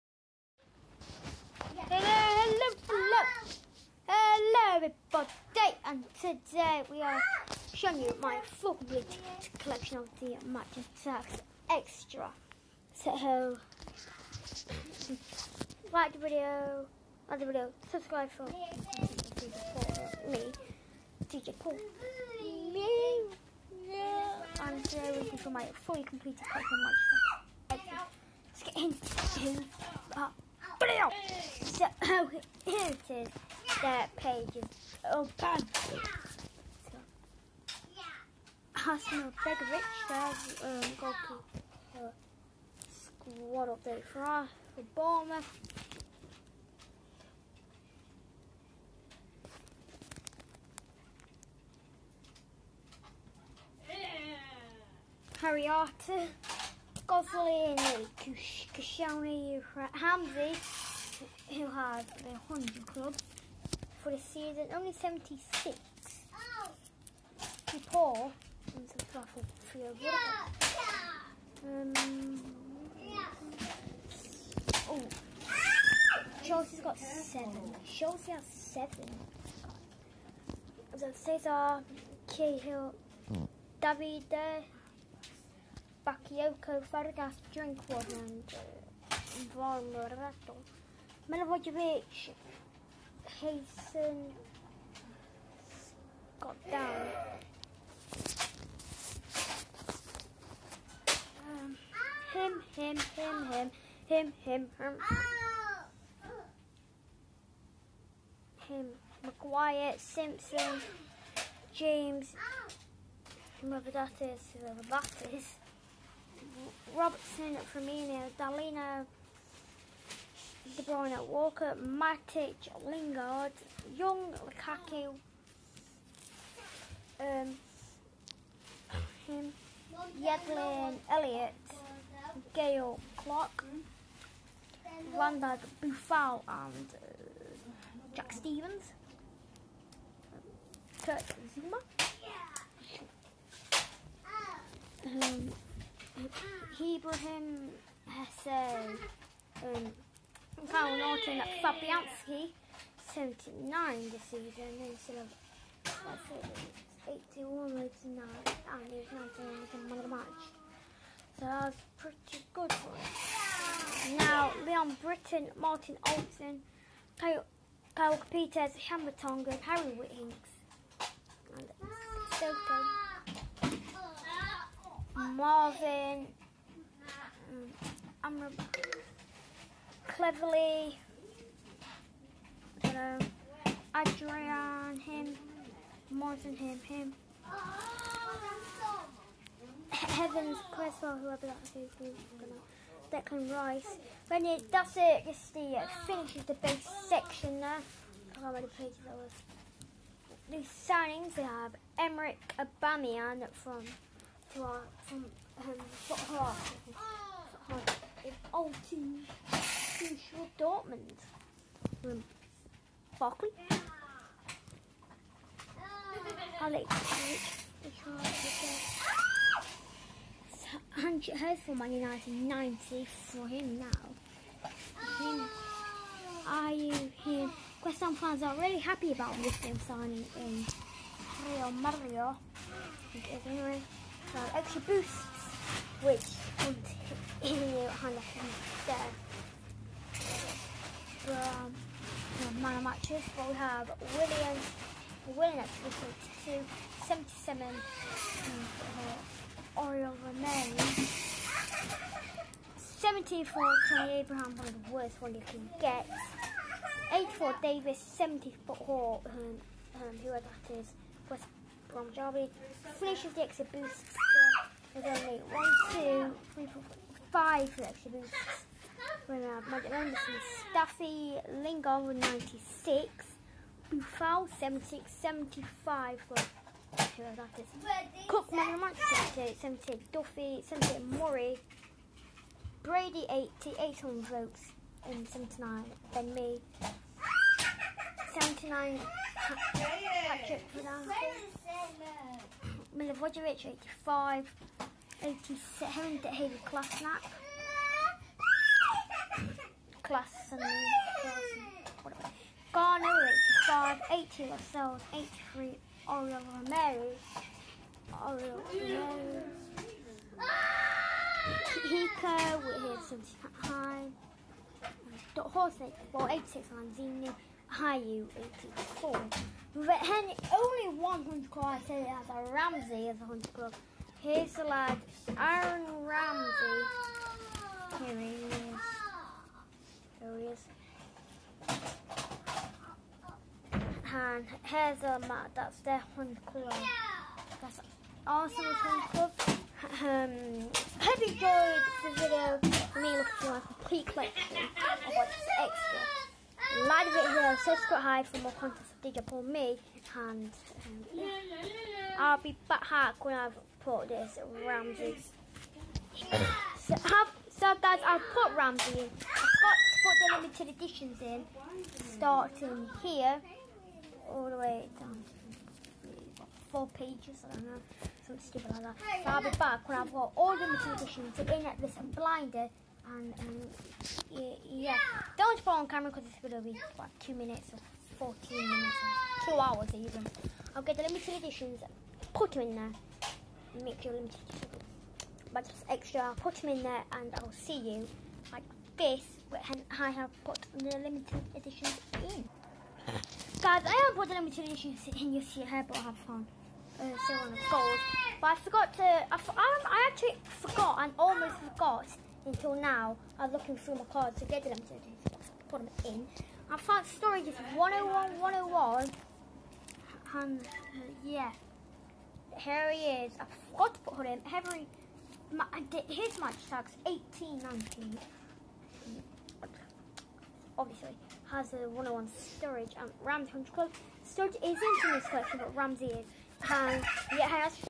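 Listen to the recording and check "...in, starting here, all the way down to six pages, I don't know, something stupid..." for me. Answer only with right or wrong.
wrong.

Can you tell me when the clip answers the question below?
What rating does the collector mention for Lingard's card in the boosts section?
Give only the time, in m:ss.
4:31.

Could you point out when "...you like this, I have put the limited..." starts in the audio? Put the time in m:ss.
6:27.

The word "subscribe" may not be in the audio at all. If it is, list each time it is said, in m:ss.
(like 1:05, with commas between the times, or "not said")
0:17, 5:47.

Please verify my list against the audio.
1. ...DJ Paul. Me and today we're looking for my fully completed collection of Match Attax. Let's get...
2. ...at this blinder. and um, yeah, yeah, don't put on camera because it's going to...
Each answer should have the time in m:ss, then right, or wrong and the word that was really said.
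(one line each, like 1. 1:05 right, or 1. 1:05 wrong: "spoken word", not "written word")
1. 0:21 right
2. 6:11 right.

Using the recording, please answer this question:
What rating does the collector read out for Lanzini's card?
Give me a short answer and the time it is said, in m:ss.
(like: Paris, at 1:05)
86, at 5:16.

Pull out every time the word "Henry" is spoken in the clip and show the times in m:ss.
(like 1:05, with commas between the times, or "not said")
4:55, 5:19.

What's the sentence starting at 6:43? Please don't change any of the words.
I'm looking through my cards to get the limited editions, put them in.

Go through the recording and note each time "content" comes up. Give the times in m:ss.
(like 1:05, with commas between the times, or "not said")
5:48.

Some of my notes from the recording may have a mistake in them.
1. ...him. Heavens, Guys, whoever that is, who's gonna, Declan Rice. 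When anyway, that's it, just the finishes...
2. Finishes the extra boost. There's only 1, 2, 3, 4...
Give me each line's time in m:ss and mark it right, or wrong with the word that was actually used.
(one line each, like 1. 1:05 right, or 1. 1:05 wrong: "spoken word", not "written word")
1. 3:06 wrong: "Cresswell", not "Guys"
2. 4:22 right.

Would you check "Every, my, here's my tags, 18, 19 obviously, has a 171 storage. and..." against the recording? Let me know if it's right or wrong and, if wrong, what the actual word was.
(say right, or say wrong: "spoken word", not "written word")
wrong: "101", not "171".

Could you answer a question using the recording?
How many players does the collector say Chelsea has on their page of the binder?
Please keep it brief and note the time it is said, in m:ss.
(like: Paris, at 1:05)
7, at 1:17.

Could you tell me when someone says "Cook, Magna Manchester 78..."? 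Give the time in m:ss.
4:38.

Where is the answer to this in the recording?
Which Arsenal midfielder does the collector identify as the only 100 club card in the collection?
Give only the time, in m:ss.
5:25.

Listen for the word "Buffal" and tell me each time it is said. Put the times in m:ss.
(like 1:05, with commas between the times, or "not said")
2:15, 4:33.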